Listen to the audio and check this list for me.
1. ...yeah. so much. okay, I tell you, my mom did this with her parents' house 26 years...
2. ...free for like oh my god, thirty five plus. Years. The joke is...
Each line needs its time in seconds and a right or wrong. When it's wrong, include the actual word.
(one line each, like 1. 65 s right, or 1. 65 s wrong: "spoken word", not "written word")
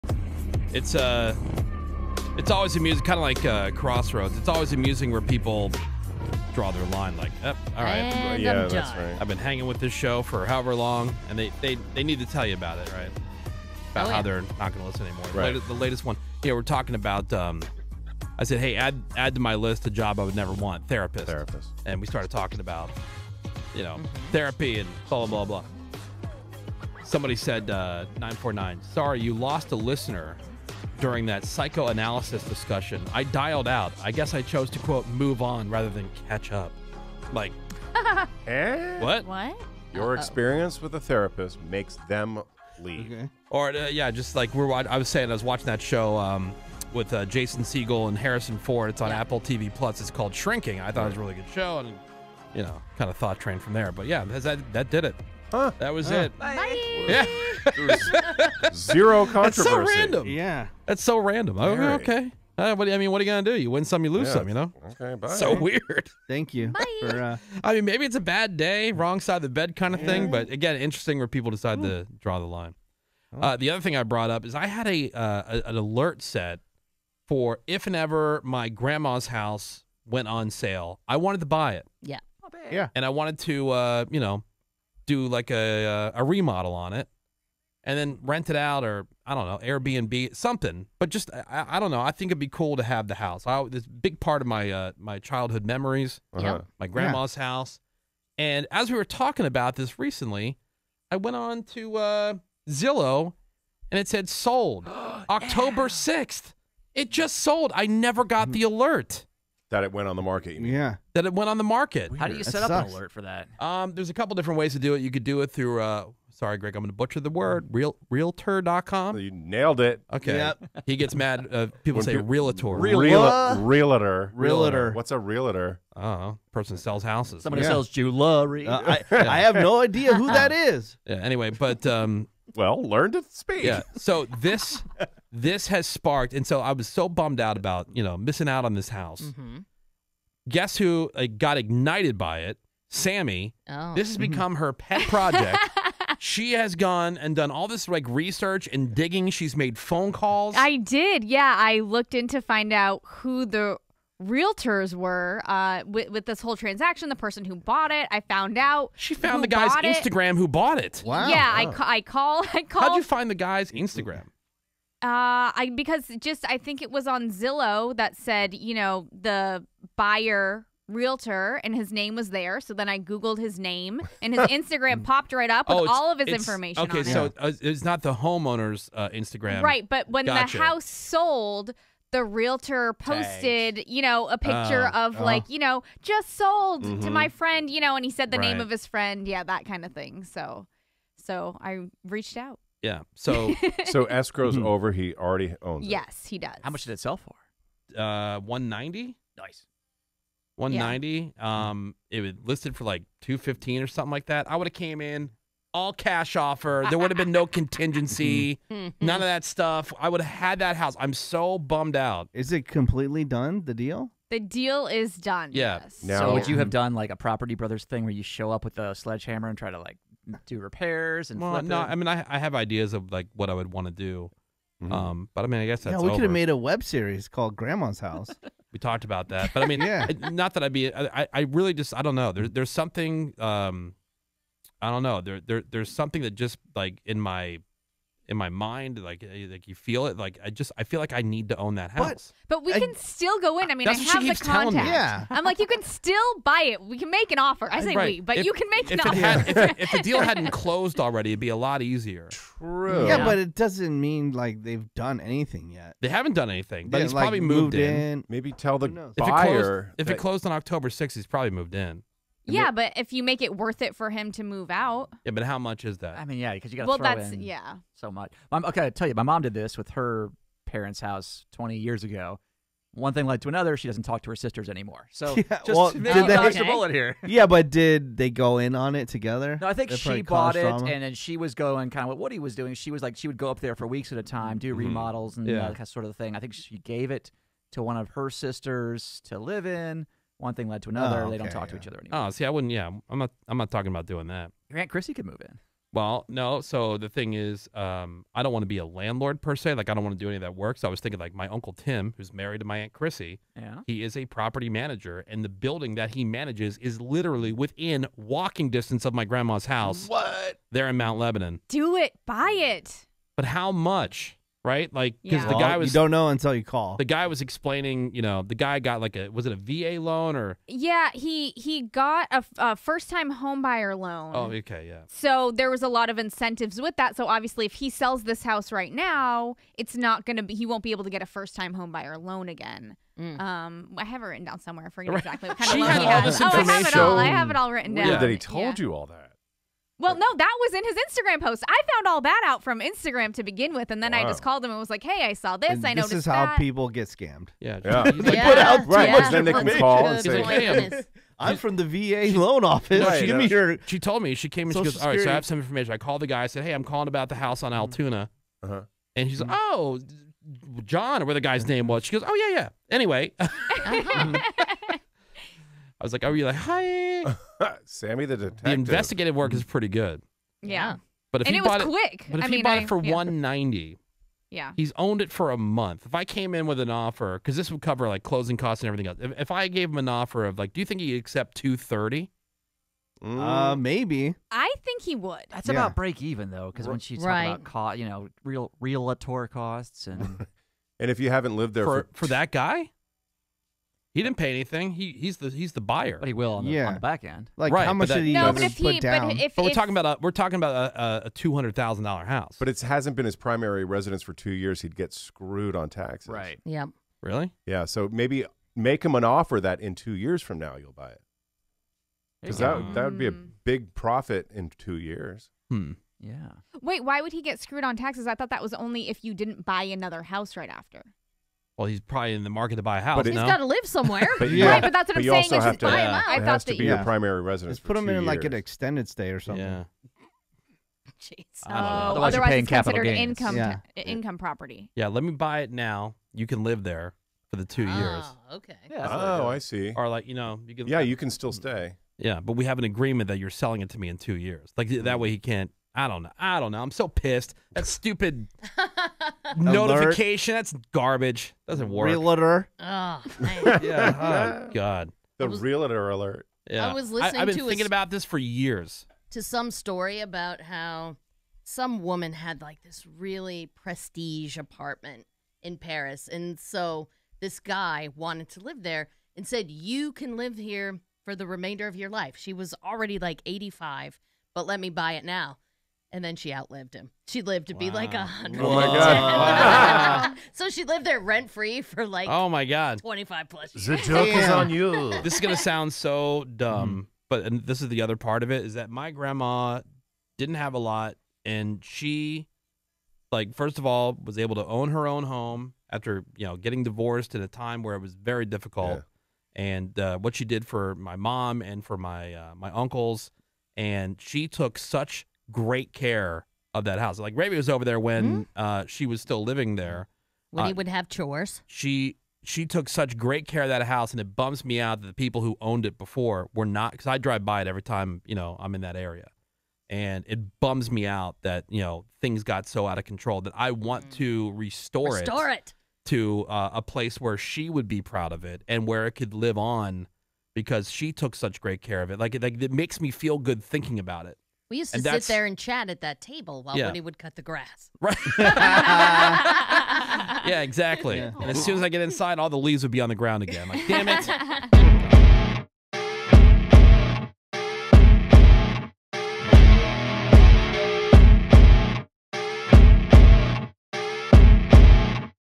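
1. 267 s wrong: "20", not "26"
2. 481 s wrong: "twenty", not "thirty".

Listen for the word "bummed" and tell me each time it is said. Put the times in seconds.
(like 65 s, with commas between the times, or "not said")
137 s, 211 s.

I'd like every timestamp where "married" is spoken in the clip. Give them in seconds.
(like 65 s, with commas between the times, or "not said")
302 s.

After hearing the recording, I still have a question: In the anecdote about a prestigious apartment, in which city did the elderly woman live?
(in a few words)
Paris.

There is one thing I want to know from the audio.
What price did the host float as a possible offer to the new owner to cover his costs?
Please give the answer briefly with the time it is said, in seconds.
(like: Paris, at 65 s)
230, at 381 s.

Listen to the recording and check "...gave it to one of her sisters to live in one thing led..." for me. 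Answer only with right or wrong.
right.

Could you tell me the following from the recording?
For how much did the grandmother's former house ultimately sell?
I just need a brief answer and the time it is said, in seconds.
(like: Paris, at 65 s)
190, at 198 s.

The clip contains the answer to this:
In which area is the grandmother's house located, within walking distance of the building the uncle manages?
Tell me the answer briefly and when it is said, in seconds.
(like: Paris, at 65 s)
Mount Lebanon, at 310 s.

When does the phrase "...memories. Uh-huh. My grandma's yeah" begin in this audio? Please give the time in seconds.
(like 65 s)
95 s.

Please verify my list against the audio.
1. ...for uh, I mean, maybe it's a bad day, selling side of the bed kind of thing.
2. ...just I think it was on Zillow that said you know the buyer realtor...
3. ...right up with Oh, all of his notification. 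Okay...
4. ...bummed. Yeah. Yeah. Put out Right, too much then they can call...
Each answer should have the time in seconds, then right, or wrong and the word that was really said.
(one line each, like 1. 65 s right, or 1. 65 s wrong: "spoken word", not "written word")
1. 67 s wrong: "wrong", not "selling"
2. 166 s right
3. 175 s wrong: "information", not "notification"
4. 347 s wrong: "scammed", not "bummed".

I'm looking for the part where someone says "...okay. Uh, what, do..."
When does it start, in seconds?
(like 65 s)
61 s.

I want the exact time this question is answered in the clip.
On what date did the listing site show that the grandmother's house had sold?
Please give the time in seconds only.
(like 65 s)
105 s.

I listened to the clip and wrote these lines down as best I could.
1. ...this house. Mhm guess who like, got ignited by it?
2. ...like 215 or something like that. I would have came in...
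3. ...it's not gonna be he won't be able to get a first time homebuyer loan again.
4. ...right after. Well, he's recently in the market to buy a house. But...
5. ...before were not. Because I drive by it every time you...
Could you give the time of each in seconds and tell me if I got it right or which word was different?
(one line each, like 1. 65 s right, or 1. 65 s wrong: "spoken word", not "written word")
1. 138 s right
2. 202 s right
3. 329 s right
4. 420 s wrong: "probably", not "recently"
5. 515 s right.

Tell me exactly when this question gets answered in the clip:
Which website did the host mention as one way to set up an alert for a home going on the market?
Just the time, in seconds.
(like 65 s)
118 s.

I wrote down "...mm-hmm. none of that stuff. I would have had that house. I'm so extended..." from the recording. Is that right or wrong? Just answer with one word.
wrong.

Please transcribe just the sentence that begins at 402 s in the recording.
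But it hasn't been his primary residence for two years.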